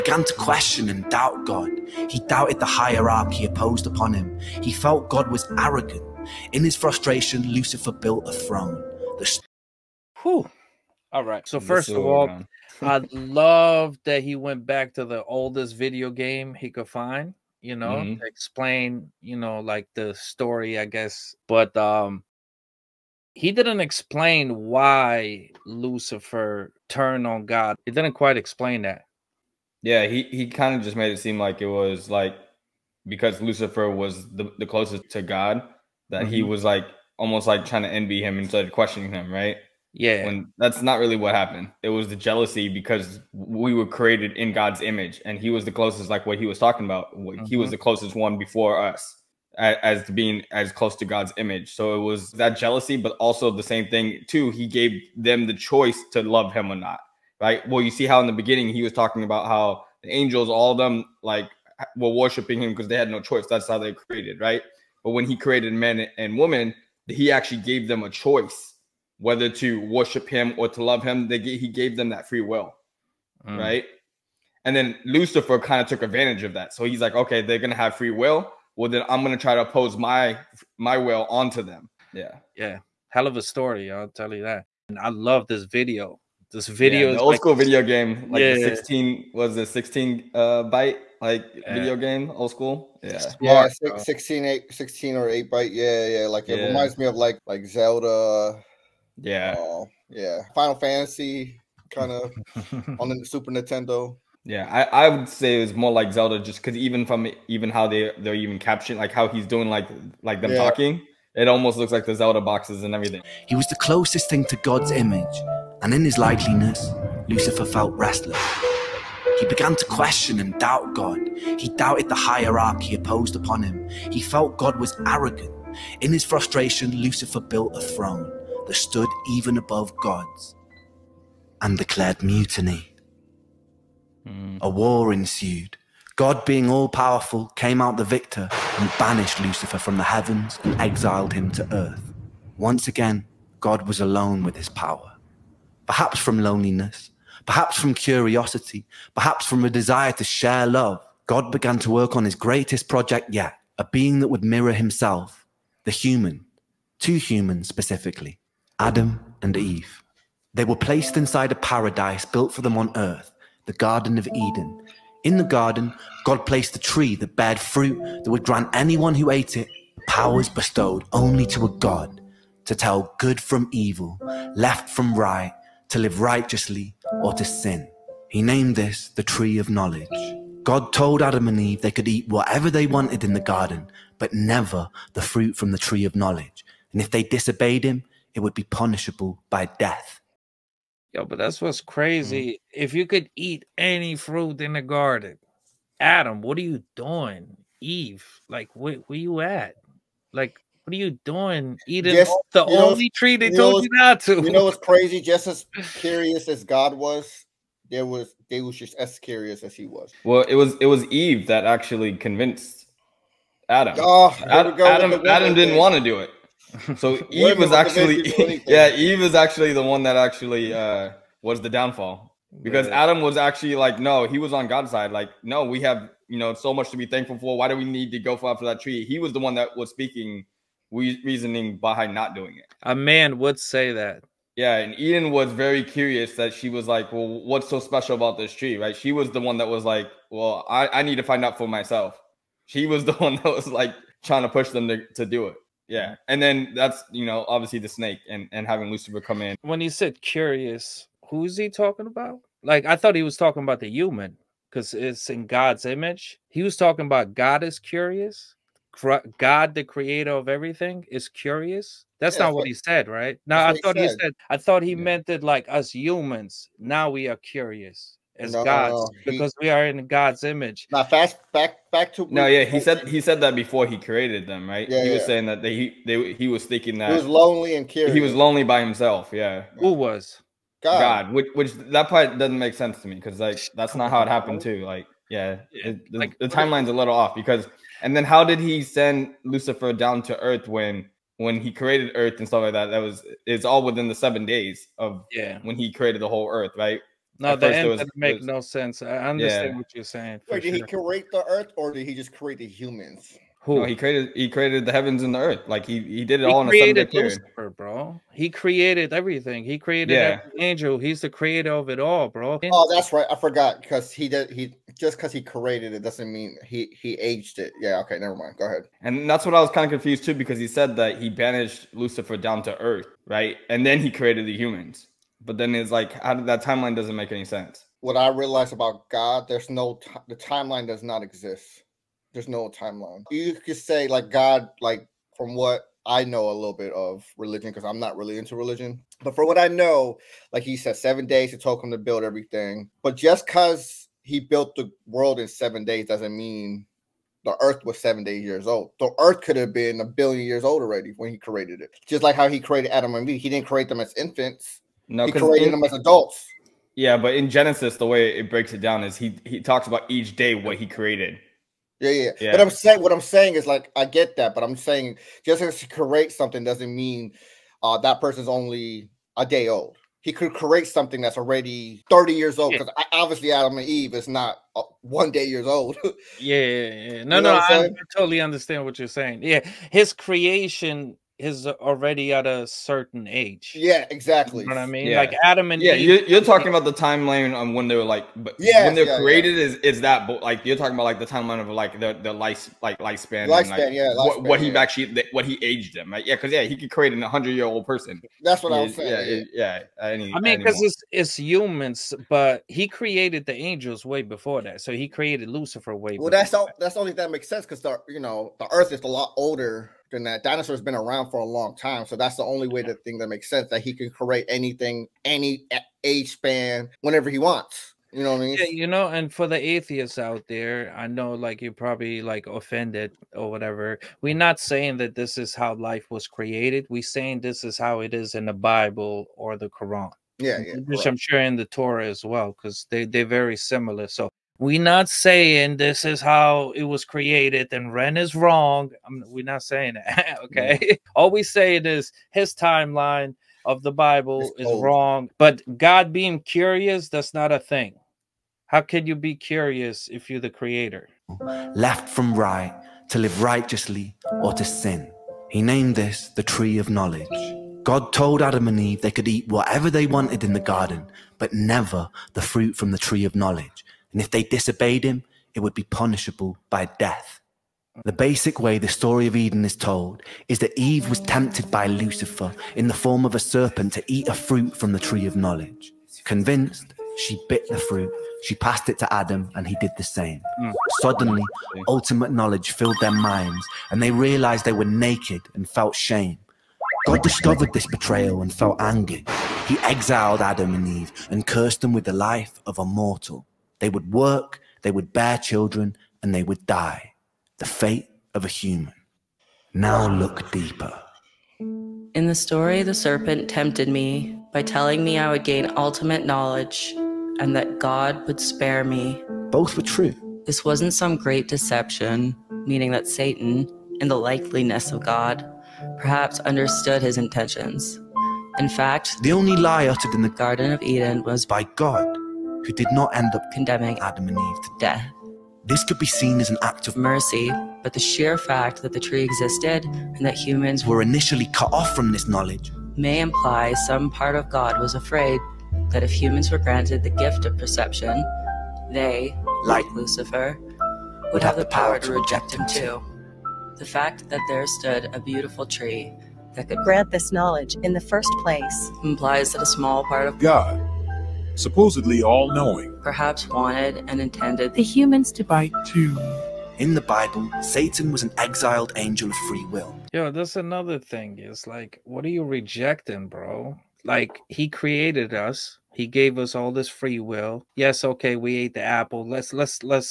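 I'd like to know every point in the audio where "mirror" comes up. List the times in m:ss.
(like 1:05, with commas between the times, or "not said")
2:34.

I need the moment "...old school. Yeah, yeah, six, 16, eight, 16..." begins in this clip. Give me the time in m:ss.
1:32.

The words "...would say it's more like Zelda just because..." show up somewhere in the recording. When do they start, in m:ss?
1:45.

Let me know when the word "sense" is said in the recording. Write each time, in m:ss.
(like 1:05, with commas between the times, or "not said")
4:42, 4:58, 5:27, 6:47, 6:53.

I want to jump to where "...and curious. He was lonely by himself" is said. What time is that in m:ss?
4:37.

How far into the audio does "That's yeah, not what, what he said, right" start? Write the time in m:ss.
4:22.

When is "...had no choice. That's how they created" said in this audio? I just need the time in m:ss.
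1:02.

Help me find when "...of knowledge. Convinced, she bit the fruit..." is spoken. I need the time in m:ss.
7:55.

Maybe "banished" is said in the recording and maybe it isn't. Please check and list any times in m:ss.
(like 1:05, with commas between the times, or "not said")
2:18, 5:21.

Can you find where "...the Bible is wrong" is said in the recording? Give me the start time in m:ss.
7:23.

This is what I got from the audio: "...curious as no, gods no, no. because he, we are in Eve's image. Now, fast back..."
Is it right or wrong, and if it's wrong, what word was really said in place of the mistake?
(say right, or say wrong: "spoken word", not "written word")
wrong: "God", not "Eve".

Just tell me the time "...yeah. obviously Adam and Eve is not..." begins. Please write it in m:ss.
6:12.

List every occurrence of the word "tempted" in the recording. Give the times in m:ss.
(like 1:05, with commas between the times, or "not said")
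7:51, 8:23.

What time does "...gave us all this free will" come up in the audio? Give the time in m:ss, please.
9:26.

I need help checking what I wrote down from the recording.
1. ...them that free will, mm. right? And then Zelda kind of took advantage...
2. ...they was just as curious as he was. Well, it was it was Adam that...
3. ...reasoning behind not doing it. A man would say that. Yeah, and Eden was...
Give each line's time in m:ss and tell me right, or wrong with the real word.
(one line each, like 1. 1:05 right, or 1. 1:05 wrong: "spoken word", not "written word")
1. 1:11 wrong: "Lucifer", not "Zelda"
2. 3:28 wrong: "Eve", not "Adam"
3. 3:51 right.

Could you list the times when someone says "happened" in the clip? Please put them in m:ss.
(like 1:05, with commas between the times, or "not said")
0:41, 4:44.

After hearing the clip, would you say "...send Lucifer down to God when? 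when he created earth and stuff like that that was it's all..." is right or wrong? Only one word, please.
wrong.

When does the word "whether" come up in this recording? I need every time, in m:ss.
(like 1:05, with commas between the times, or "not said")
1:09.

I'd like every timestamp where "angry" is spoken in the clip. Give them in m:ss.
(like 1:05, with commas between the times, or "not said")
8:08.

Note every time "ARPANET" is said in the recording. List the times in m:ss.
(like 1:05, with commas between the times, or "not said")
not said.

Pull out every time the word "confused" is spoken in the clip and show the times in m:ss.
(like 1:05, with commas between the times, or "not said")
5:19.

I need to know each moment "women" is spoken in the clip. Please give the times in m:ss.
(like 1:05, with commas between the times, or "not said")
1:06.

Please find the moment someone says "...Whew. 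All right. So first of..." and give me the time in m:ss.
0:10.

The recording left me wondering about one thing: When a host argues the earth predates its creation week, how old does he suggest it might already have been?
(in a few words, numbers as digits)
A billion years.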